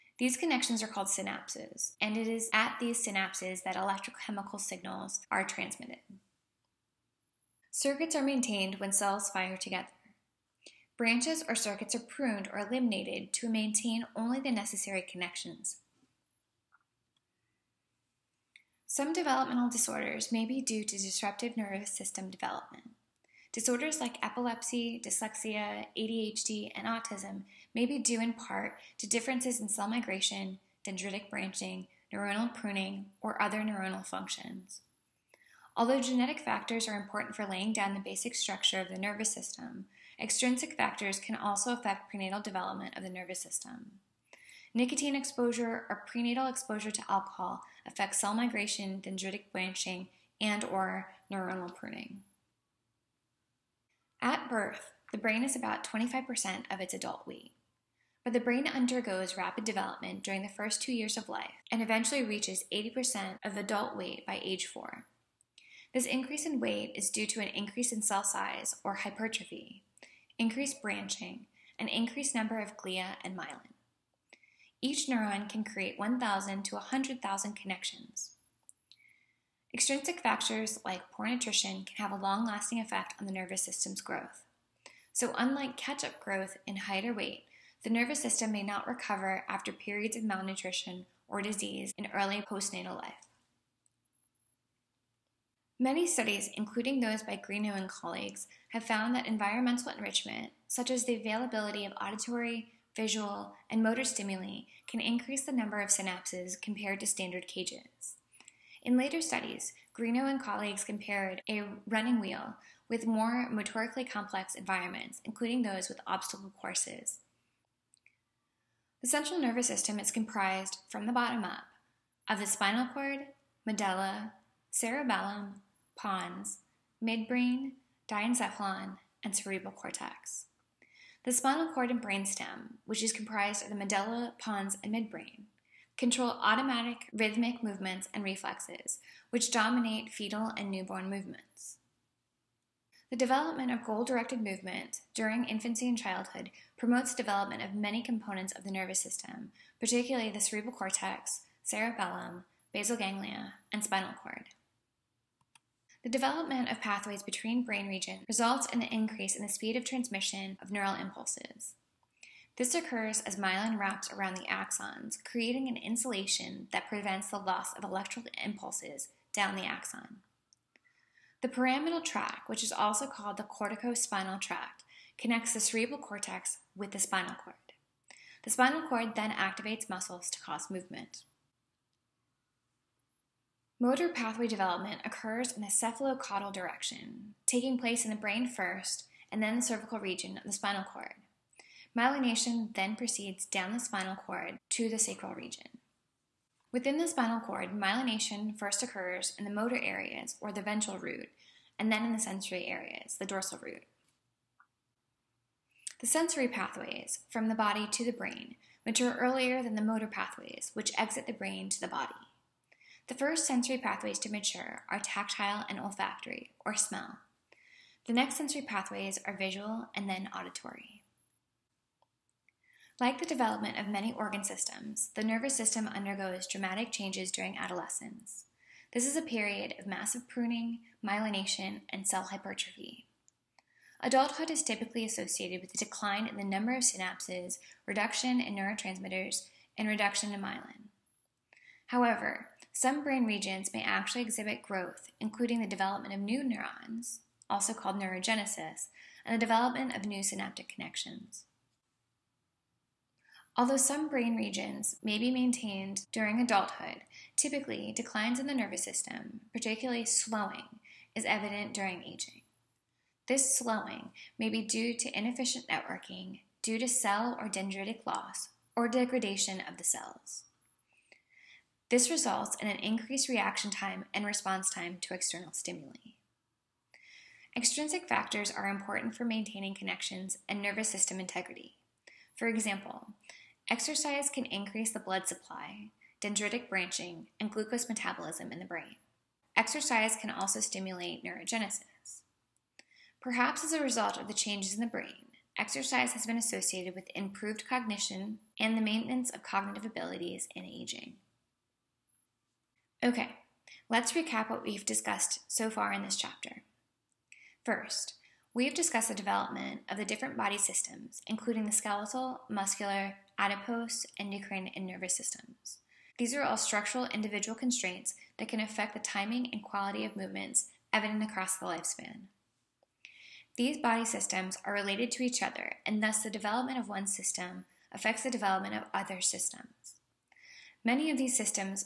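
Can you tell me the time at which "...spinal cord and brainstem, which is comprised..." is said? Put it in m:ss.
2:11.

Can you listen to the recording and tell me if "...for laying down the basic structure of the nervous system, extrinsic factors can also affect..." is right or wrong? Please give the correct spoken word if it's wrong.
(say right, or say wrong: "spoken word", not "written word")
right.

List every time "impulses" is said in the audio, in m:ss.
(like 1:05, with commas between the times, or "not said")
2:40, 2:48.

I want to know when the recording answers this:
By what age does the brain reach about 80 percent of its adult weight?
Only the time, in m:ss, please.
1:04.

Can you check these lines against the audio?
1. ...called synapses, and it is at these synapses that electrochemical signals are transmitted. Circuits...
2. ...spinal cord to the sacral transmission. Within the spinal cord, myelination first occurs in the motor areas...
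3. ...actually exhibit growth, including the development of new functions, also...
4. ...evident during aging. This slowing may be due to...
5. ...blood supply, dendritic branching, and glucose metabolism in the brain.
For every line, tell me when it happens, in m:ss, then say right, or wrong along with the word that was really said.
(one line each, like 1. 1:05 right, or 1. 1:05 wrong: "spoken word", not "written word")
1. 0:00 right
2. 3:13 wrong: "region", not "transmission"
3. 4:03 wrong: "neurons", not "functions"
4. 4:21 right
5. 4:44 right.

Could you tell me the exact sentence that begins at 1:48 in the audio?
In later studies, Greenough and colleagues compared a running wheel with more motorically complex environments, including those with obstacle courses.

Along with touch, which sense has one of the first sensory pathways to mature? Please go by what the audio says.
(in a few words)
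smell.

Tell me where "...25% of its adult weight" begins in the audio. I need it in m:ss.
0:55.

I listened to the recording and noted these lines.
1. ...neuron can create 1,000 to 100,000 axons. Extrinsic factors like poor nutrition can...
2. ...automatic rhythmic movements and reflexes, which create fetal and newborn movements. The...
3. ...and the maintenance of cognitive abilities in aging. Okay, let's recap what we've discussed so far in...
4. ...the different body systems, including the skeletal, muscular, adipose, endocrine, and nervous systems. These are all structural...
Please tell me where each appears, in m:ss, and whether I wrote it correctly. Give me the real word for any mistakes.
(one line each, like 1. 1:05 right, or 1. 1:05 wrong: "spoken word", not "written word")
1. 1:15 wrong: "connections", not "axons"
2. 2:16 wrong: "dominate", not "create"
3. 4:58 right
4. 5:09 right.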